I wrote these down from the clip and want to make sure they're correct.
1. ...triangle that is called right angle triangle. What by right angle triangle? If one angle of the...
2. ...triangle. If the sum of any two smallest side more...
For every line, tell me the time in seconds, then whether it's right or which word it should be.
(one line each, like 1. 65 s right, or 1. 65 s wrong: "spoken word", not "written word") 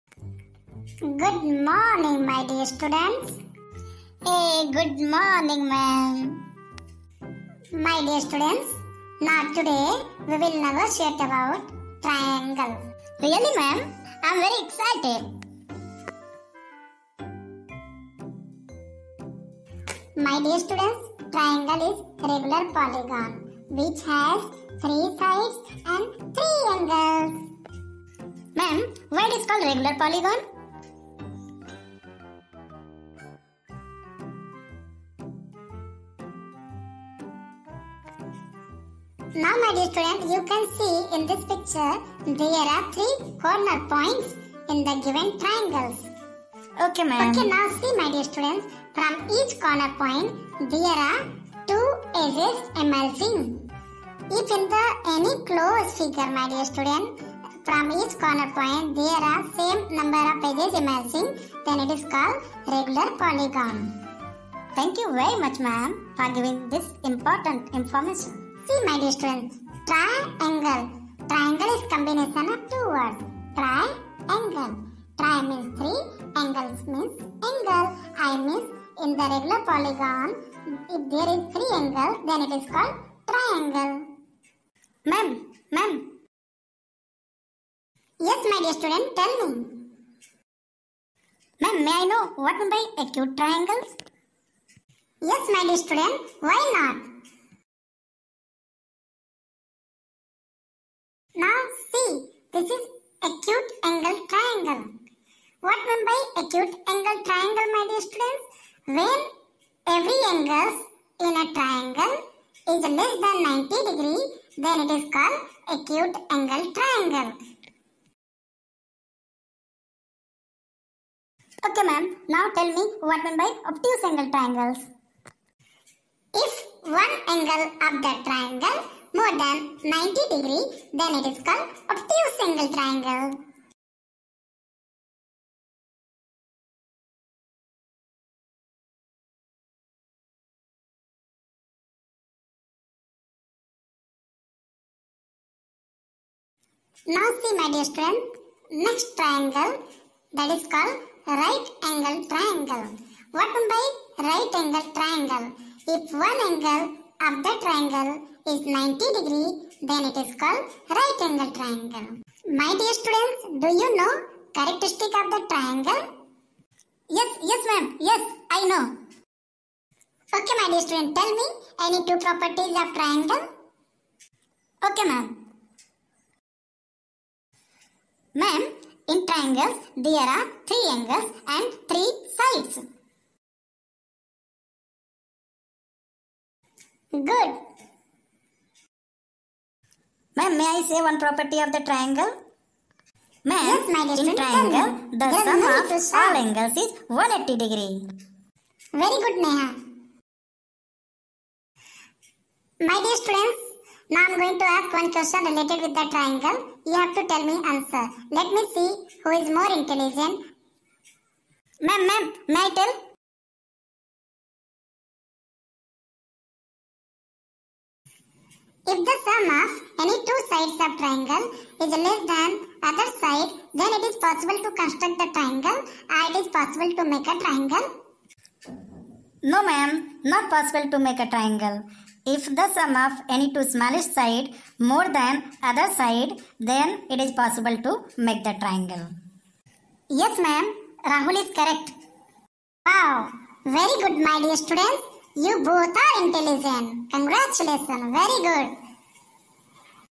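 1. 149 s right
2. 231 s right.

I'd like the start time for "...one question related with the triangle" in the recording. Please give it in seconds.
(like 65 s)
204 s.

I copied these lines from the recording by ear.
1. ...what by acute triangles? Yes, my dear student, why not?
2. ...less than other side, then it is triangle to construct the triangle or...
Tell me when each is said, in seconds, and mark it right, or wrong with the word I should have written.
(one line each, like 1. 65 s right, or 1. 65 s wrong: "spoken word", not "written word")
1. 92 s right
2. 222 s wrong: "possible", not "triangle".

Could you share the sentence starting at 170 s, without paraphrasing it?
Okay my dear student, tell me any two properties of triangle?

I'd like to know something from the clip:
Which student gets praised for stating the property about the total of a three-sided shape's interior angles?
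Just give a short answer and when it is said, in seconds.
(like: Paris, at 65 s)
Neha, at 199 s.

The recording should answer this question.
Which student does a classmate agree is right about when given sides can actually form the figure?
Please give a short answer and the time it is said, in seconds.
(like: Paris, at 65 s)
Rahul, at 241 s.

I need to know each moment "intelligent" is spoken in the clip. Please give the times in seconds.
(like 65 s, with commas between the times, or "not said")
209 s, 246 s.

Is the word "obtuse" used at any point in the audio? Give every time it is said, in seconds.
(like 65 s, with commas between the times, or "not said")
123 s, 131 s.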